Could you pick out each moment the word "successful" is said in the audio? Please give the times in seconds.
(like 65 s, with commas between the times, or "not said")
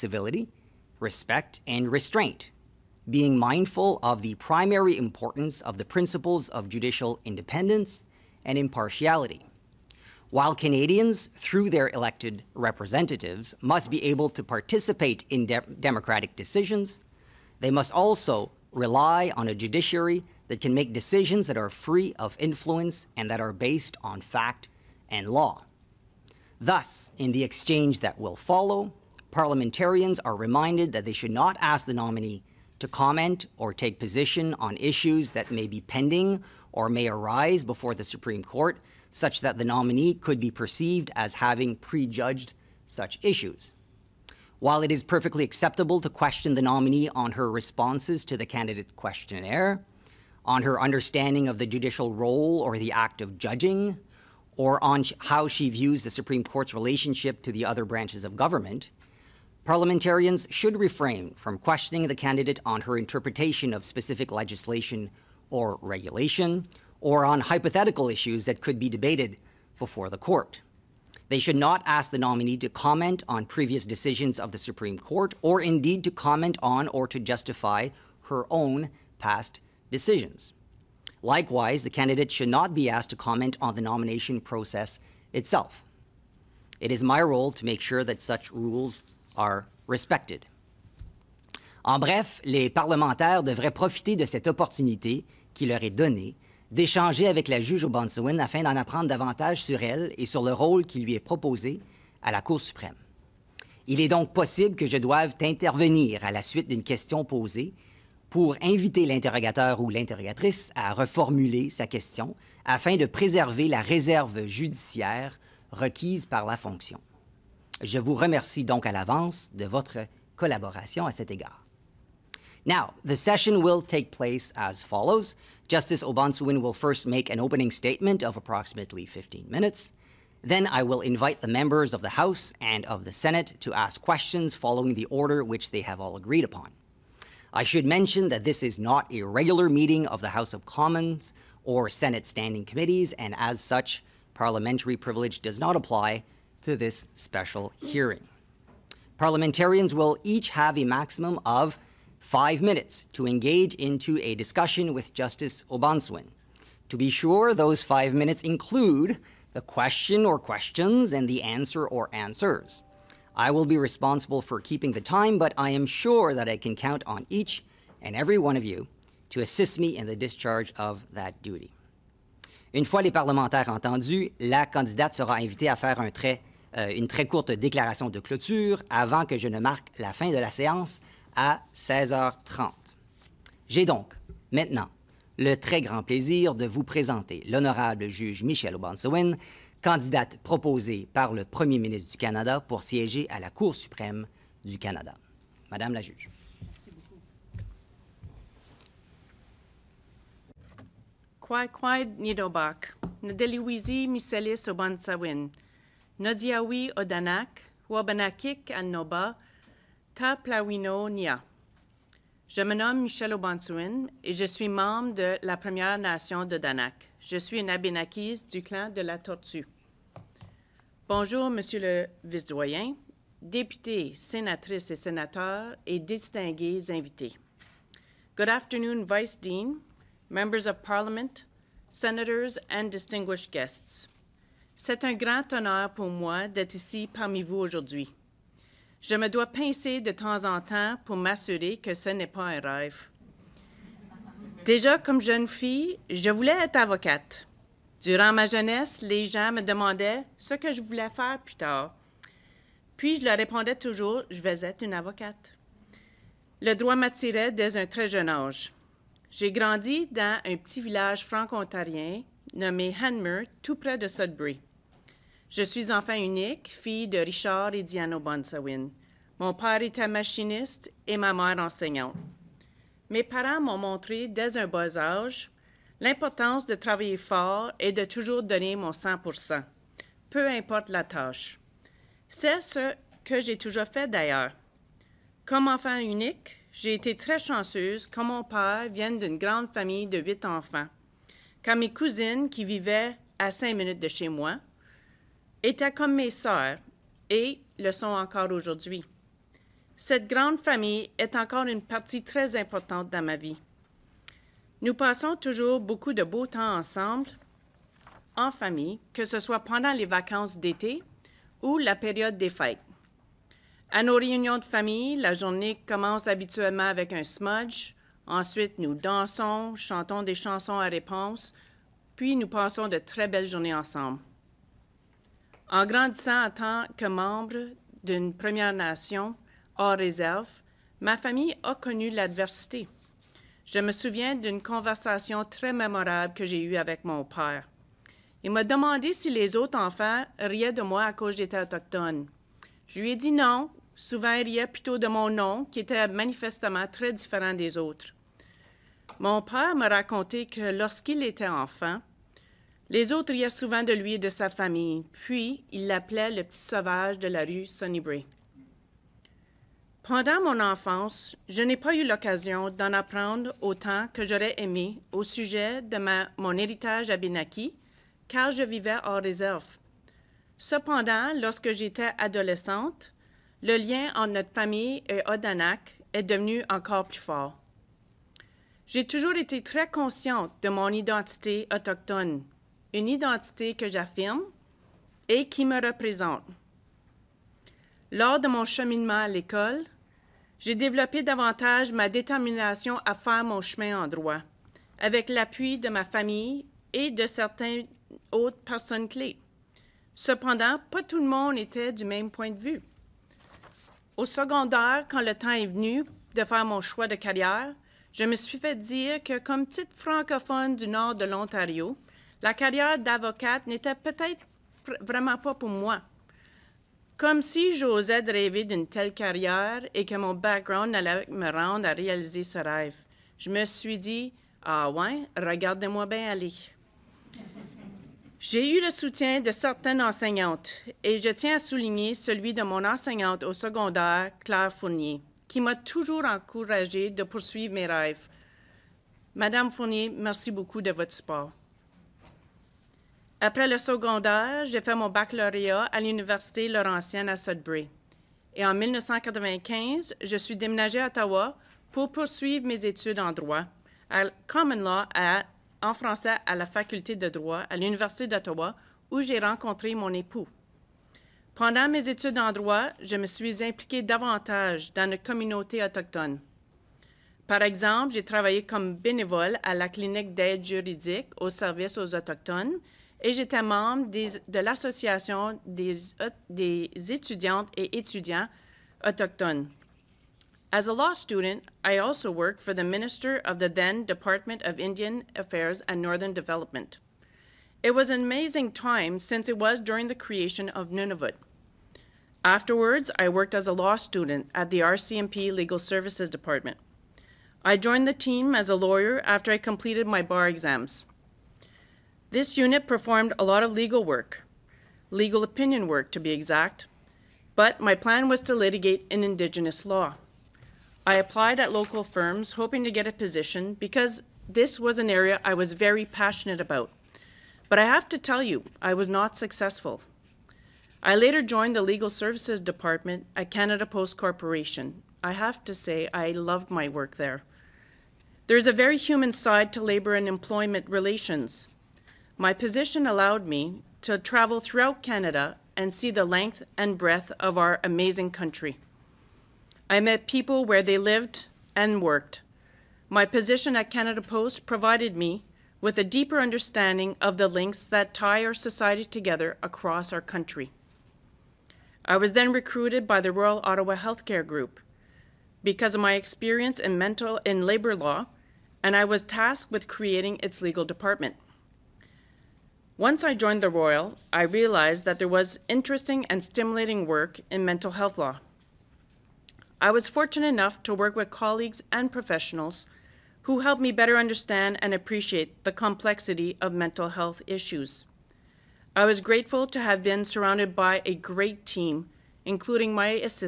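519 s.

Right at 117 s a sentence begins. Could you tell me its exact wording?
Je vous remercie donc à l'avance de votre collaboration à cet égard.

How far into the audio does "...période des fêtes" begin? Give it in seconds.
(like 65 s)
311 s.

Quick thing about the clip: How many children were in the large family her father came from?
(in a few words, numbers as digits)
8.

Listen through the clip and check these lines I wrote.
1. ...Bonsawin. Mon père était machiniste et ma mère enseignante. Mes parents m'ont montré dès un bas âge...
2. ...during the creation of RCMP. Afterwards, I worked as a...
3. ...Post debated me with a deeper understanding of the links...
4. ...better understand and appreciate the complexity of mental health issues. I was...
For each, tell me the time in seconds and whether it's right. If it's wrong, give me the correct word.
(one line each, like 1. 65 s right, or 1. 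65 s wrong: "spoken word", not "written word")
1. 268 s right
2. 489 s wrong: "Nunavut", not "RCMP"
3. 544 s wrong: "provided", not "debated"
4. 573 s right.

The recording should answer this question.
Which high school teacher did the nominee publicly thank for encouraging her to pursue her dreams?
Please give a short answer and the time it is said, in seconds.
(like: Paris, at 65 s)
Claire Fournier, at 434 s.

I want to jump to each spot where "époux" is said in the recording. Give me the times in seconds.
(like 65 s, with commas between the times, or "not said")
460 s.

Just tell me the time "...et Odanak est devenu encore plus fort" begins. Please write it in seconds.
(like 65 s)
375 s.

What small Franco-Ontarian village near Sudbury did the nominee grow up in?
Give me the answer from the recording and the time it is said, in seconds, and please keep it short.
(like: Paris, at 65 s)
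Hanmer, at 263 s.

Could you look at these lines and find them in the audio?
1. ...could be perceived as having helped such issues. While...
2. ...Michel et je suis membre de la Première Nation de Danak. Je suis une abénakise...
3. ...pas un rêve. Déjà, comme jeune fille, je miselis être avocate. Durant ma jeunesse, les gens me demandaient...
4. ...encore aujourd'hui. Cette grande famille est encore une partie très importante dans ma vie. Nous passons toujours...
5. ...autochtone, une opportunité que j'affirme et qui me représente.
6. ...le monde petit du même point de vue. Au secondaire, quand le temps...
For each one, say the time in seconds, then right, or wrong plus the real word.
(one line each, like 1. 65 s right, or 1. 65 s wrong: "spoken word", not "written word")
1. 40 s wrong: "prejudged", not "helped"
2. 213 s right
3. 242 s wrong: "voulais", not "miselis"
4. 298 s right
5. 381 s wrong: "identité", not "opportunité"
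6. 401 s wrong: "était", not "petit".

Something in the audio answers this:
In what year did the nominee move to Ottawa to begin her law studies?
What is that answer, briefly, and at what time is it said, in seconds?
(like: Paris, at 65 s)
1995, at 448 s.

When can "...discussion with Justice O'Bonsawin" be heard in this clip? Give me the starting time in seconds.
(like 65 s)
154 s.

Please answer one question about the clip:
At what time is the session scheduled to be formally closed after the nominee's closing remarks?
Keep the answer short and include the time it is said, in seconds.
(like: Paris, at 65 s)
16h30, at 181 s.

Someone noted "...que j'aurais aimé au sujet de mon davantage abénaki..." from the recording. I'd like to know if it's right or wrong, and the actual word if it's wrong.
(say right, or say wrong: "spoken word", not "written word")
wrong: "héritage", not "davantage".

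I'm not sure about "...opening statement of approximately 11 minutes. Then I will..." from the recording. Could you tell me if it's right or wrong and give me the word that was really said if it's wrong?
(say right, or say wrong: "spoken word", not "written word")
wrong: "15", not "11".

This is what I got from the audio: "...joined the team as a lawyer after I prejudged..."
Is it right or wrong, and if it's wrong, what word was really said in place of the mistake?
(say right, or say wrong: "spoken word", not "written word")
wrong: "completed", not "prejudged".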